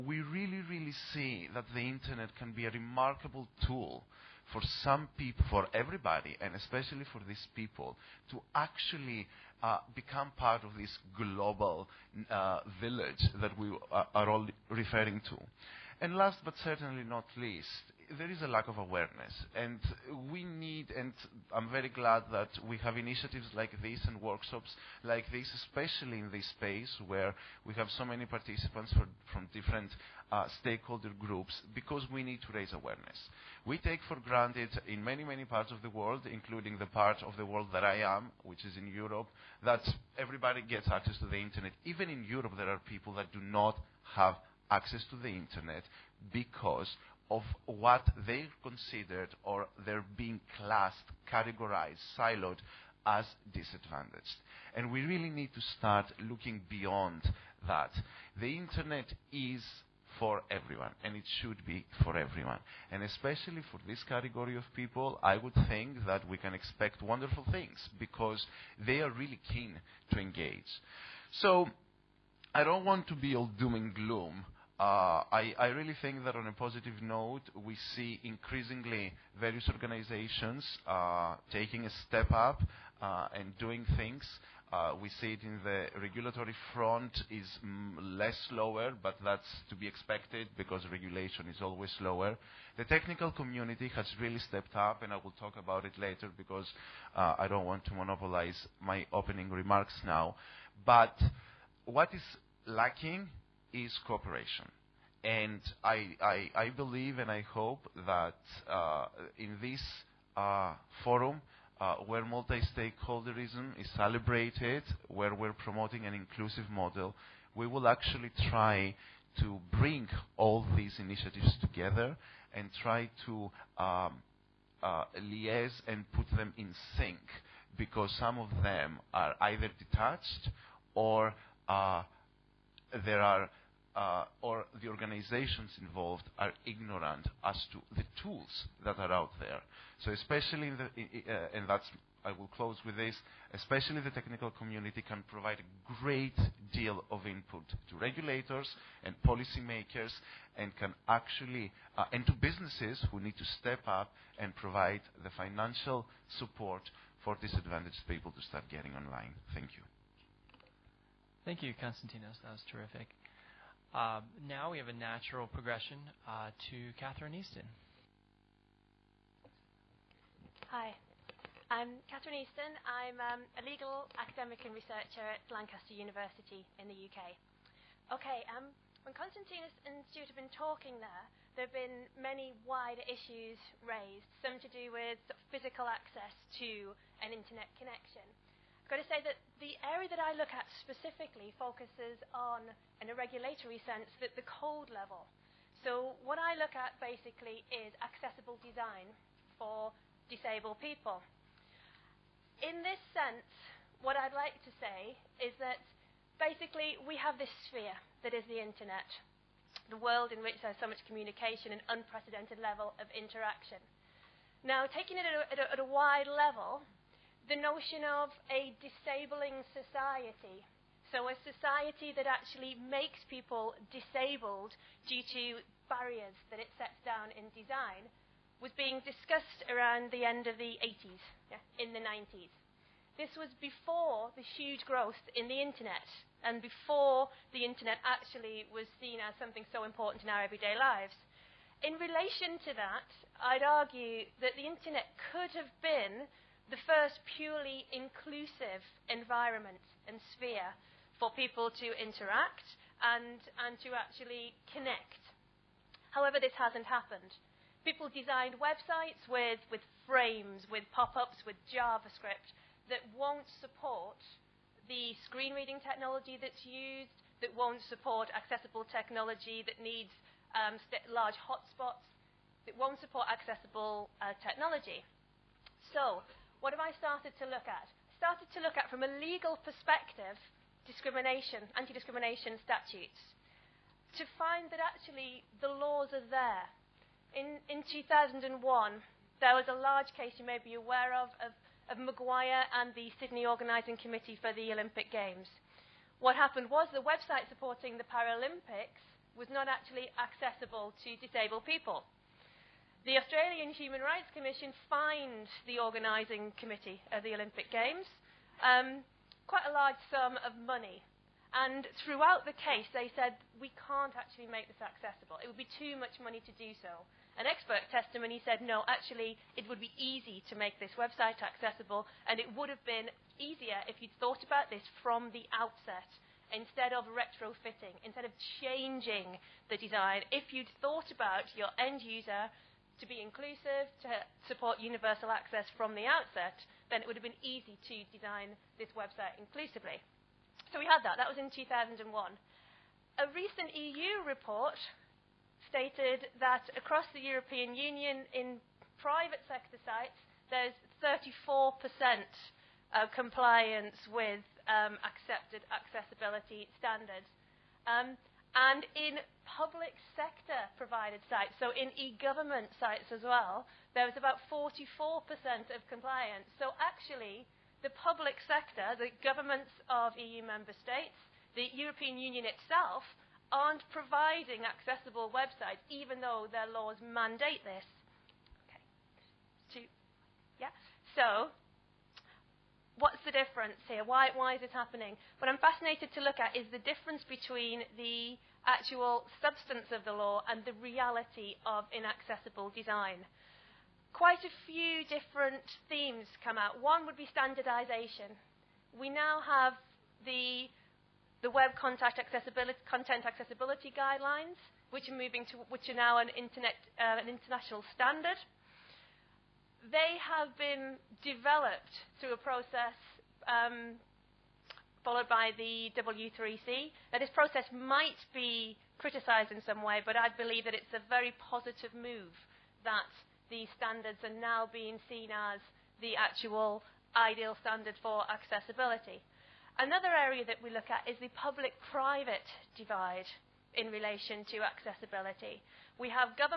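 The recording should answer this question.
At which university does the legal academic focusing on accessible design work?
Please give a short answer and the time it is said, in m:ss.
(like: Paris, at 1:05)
Lancaster University, at 2:55.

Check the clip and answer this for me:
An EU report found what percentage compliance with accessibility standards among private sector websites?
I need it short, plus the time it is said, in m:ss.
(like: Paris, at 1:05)
34%, at 5:51.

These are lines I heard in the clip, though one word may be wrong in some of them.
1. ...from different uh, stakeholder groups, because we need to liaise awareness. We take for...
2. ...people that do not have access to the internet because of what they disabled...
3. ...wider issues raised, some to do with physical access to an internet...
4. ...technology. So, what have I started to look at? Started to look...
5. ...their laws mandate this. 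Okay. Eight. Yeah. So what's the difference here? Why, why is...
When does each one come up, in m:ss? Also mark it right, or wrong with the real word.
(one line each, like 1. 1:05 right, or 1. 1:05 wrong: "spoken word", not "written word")
1. 0:29 wrong: "raise", not "liaise"
2. 0:42 wrong: "considered", not "disabled"
3. 3:02 right
4. 4:34 right
5. 6:16 wrong: "Two", not "Eight".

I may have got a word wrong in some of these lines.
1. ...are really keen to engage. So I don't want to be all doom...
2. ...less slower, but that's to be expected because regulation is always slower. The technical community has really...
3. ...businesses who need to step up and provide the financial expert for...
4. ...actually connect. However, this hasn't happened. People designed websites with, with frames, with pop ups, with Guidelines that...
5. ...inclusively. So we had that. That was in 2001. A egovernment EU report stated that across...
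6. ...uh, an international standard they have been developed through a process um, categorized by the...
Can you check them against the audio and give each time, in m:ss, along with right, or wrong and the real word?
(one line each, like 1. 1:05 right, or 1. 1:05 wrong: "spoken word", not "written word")
1. 1:08 right
2. 1:28 right
3. 2:32 wrong: "support", not "expert"
4. 4:13 wrong: "JavaScript", not "Guidelines"
5. 5:39 wrong: "recent", not "egovernment"
6. 6:47 wrong: "followed", not "categorized".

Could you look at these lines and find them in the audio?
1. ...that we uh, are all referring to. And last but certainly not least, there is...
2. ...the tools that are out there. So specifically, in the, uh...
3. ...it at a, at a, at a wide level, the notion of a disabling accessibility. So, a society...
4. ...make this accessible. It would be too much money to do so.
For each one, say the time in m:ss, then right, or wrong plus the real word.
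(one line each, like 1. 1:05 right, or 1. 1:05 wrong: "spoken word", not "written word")
1. 0:13 right
2. 2:17 wrong: "especially", not "specifically"
3. 3:35 wrong: "society", not "accessibility"
4. 5:14 right.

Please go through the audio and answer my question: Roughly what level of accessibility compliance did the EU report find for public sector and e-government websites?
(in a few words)
44%.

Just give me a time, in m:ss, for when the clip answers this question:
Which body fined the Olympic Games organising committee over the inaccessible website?
5:03.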